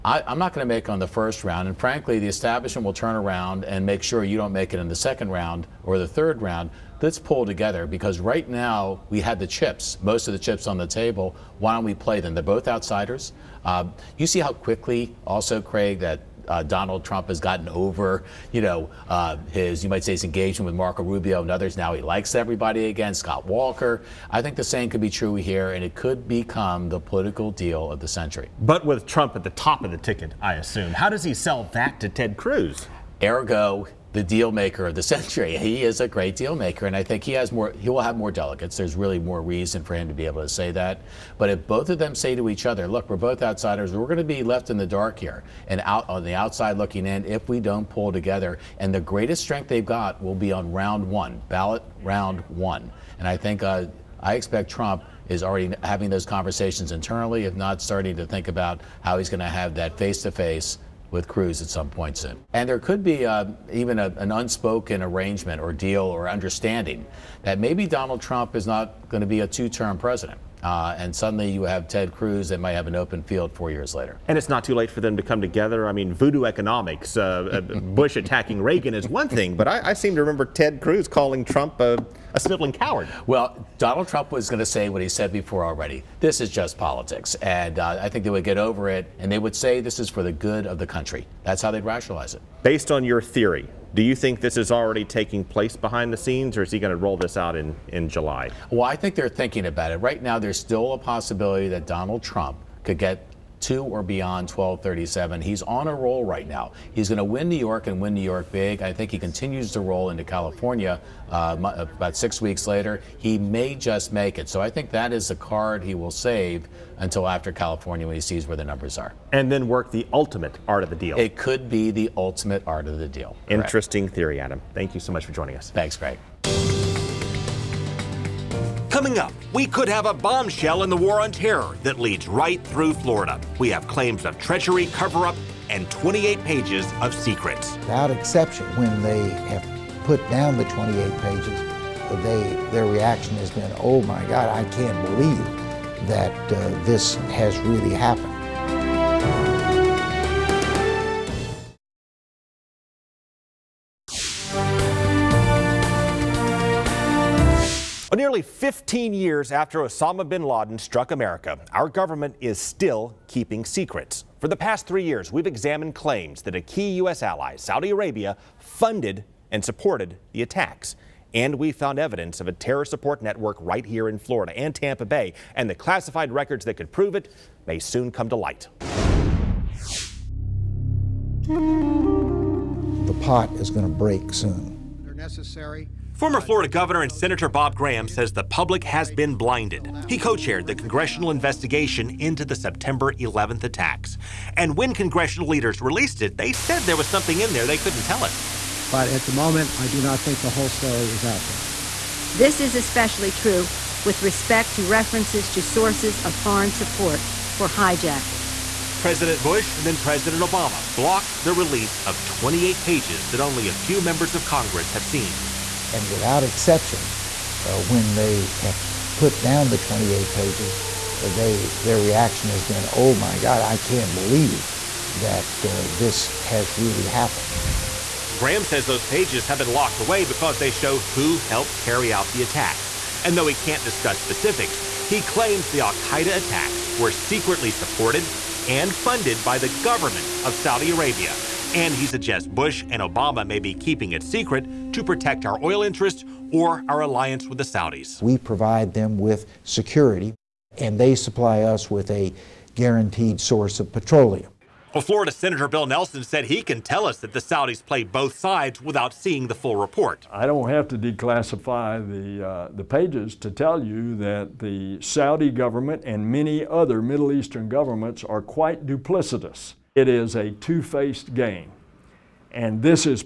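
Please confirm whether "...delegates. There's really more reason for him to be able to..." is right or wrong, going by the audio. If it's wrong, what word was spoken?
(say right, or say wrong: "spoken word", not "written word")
right.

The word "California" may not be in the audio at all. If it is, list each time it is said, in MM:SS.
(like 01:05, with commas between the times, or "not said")
01:50, 01:57.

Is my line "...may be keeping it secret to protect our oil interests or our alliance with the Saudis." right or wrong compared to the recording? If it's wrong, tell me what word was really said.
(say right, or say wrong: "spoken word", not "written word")
right.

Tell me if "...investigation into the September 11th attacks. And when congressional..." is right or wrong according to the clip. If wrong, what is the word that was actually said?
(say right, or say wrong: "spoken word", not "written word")
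right.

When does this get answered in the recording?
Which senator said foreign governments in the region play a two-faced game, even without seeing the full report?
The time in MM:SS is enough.
04:15.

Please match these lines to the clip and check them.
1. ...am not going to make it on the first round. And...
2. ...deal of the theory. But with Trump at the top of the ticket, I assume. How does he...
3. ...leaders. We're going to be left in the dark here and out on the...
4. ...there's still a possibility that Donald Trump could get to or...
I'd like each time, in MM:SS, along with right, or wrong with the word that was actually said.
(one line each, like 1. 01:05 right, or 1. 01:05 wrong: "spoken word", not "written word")
1. 00:00 right
2. 00:27 wrong: "century", not "theory"
3. 00:43 wrong: "outsiders", not "leaders"
4. 01:40 right.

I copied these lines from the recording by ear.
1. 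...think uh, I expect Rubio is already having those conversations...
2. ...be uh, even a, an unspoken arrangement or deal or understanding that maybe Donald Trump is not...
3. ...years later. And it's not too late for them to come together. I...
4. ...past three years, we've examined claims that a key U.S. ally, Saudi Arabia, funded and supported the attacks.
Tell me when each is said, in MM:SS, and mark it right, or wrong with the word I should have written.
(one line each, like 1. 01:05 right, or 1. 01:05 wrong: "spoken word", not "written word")
1. 00:53 wrong: "Trump", not "Rubio"
2. 01:03 right
3. 01:13 right
4. 02:44 right.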